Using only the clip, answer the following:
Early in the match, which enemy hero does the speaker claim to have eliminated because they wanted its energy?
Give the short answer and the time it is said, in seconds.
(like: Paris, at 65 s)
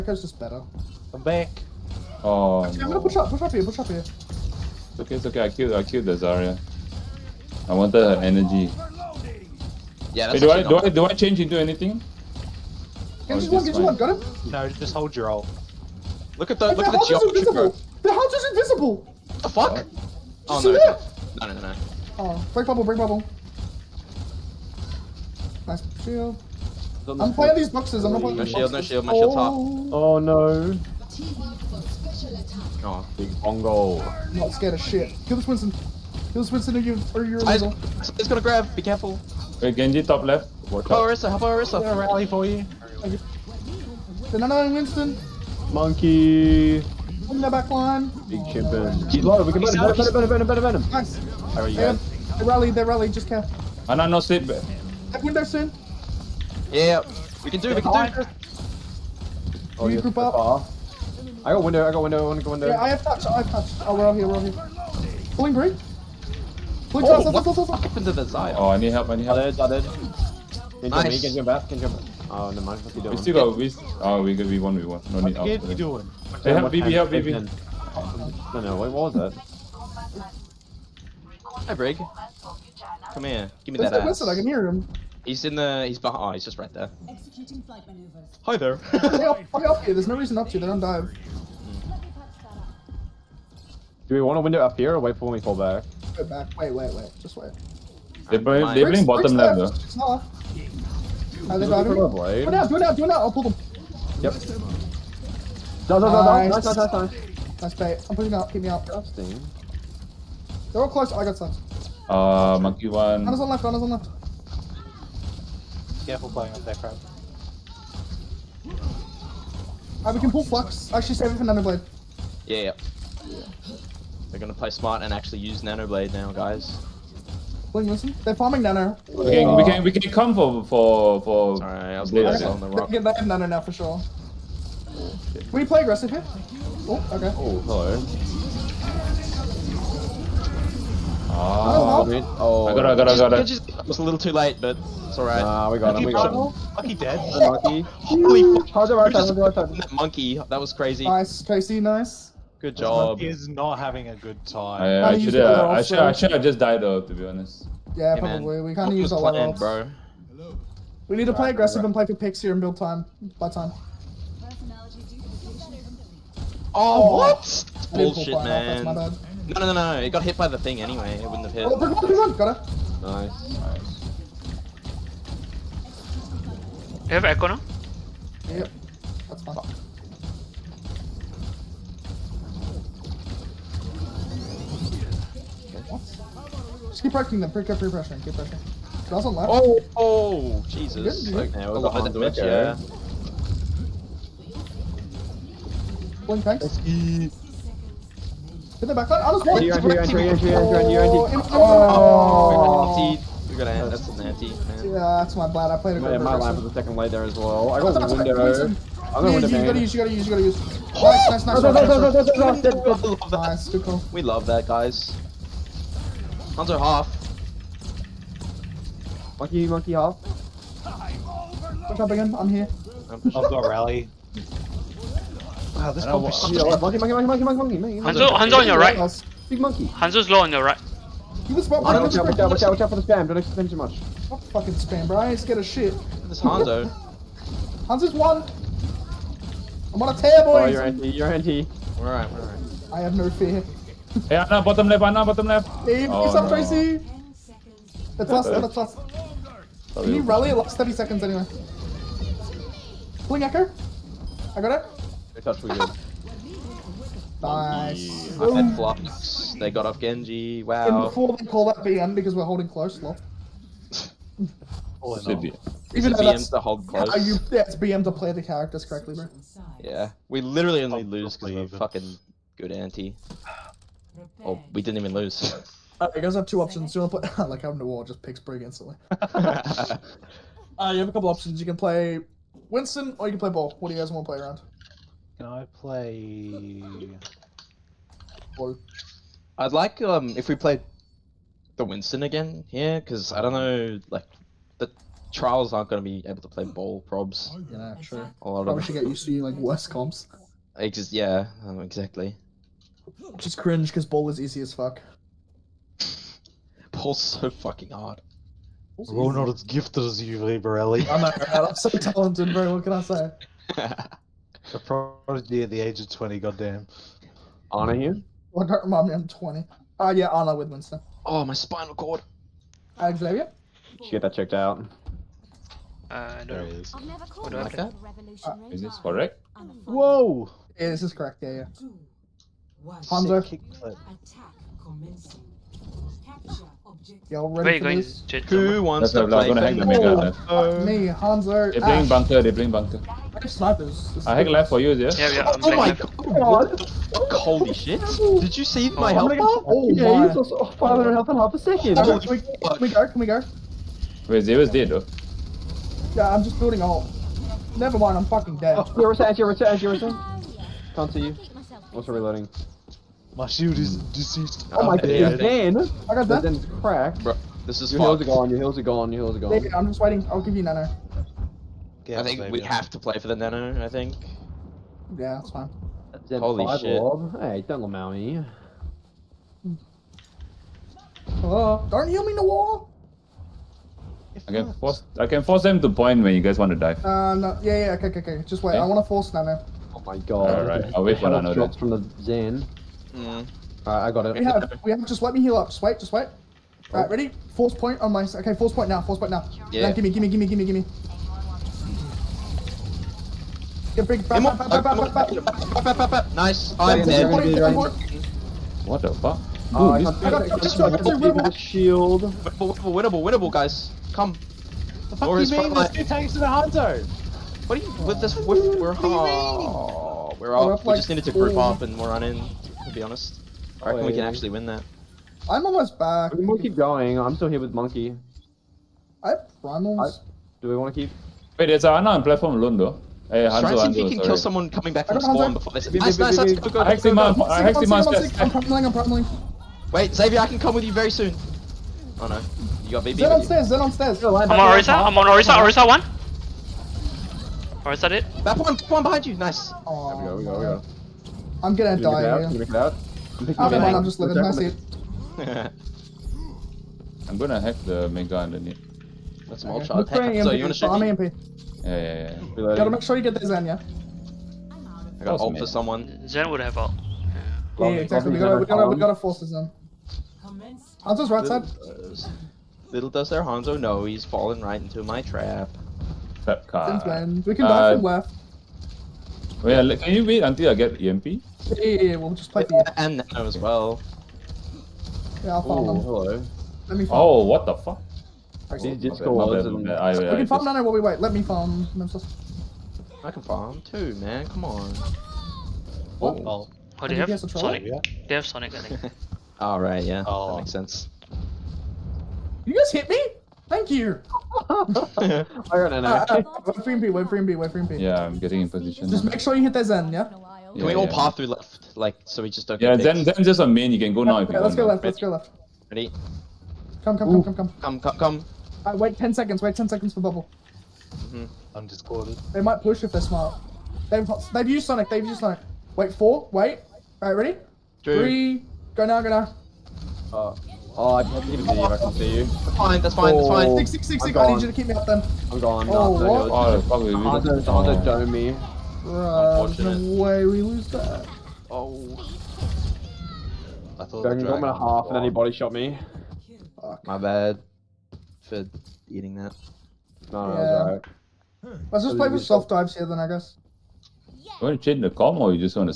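Zarya, at 5 s.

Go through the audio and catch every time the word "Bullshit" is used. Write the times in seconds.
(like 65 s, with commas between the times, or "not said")
167 s.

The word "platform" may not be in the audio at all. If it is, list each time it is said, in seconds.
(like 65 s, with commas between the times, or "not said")
432 s.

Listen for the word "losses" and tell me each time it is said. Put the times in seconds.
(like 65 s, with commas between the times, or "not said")
not said.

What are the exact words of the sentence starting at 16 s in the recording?
Look at the look the at the geometry curve.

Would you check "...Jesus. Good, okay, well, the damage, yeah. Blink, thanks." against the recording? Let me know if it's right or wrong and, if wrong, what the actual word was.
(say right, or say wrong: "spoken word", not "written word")
right.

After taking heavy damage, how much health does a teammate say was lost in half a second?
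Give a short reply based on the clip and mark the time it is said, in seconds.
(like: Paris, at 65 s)
500, at 350 s.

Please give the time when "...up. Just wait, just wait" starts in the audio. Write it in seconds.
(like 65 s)
395 s.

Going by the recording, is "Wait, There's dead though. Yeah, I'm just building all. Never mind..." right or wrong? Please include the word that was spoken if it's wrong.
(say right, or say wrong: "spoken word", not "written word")
wrong: "Zero", not "There".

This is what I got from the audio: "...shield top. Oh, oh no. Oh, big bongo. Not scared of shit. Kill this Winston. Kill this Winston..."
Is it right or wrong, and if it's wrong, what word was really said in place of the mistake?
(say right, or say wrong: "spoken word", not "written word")
right.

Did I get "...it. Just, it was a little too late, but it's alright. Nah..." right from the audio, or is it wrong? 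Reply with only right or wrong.
right.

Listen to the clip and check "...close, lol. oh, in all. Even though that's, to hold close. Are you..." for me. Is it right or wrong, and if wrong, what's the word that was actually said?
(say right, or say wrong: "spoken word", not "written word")
right.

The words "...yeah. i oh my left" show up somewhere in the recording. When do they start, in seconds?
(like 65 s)
345 s.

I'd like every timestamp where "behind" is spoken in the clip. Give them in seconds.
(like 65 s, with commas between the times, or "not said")
85 s, 101 s, 449 s.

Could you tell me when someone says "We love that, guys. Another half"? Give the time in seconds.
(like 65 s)
214 s.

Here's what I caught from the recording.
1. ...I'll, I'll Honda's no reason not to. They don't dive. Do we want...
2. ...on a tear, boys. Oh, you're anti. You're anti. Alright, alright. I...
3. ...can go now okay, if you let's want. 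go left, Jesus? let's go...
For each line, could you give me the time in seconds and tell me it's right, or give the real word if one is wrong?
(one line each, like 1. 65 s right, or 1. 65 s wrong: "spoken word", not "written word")
1. 89 s wrong: "There", not "Honda"
2. 240 s right
3. 513 s wrong: "Ready", not "Jesus".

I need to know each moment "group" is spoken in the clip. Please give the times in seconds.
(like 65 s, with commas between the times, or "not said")
60 s, 421 s.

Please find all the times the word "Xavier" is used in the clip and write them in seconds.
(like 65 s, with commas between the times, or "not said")
322 s, 440 s.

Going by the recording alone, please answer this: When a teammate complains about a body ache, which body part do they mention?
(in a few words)
spinal cord.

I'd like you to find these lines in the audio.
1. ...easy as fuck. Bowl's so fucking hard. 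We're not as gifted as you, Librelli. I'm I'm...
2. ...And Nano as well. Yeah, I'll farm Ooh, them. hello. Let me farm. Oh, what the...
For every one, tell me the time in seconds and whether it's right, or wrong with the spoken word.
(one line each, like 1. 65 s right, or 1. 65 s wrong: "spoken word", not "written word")
1. 304 s right
2. 483 s right.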